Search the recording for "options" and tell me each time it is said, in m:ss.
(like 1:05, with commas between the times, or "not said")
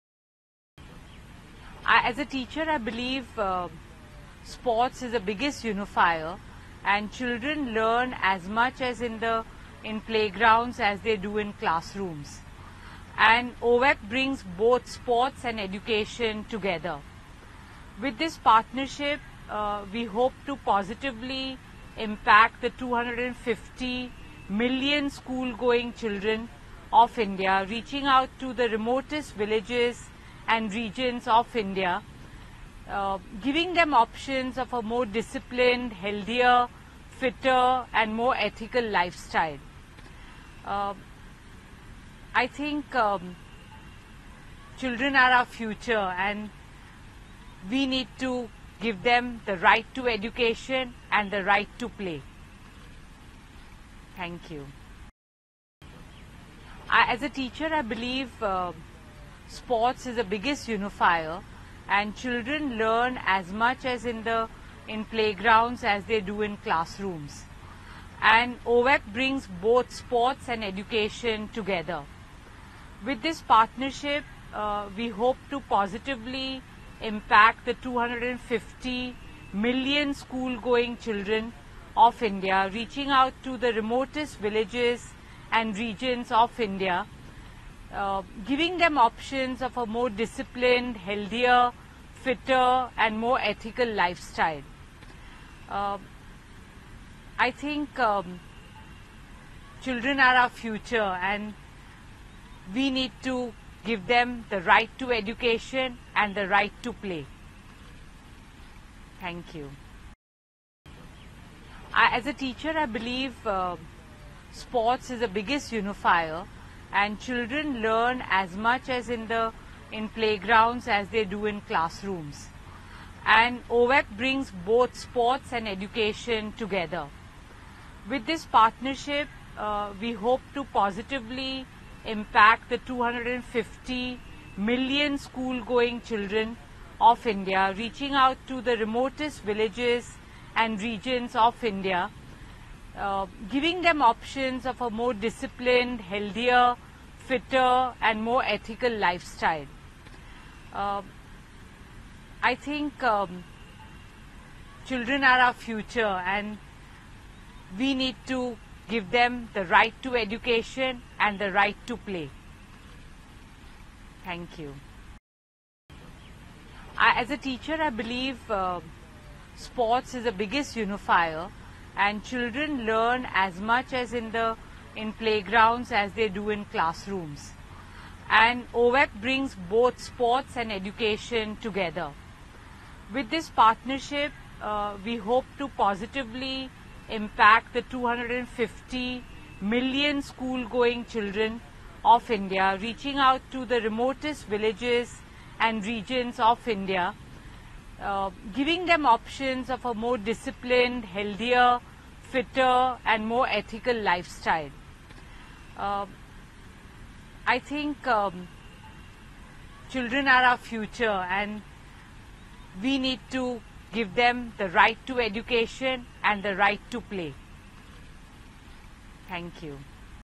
0:33, 1:28, 2:24, 3:19.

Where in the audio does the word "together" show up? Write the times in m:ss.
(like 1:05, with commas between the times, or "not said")
0:16, 1:11, 2:06, 3:01.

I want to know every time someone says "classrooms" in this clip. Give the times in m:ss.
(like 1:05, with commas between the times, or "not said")
0:11, 1:06, 2:01, 2:56.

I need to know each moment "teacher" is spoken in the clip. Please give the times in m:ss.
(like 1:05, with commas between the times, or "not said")
0:02, 0:57, 1:52, 2:47.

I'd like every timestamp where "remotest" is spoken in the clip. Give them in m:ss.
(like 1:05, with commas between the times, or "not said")
0:28, 1:23, 2:18, 3:13.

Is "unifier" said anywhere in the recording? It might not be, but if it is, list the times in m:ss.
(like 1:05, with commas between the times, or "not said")
0:05, 1:00, 1:55, 2:50.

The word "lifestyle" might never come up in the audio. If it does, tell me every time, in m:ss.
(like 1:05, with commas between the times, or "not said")
0:38, 1:33, 2:28, 3:23.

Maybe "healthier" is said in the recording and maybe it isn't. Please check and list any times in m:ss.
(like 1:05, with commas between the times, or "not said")
0:35, 1:30, 2:26, 3:21.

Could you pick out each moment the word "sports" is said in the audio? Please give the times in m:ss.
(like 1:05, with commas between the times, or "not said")
0:04, 0:14, 0:59, 1:09, 1:54, 2:04, 2:49, 3:00.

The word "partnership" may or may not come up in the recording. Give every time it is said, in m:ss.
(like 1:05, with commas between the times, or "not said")
0:18, 1:13, 2:08, 3:03.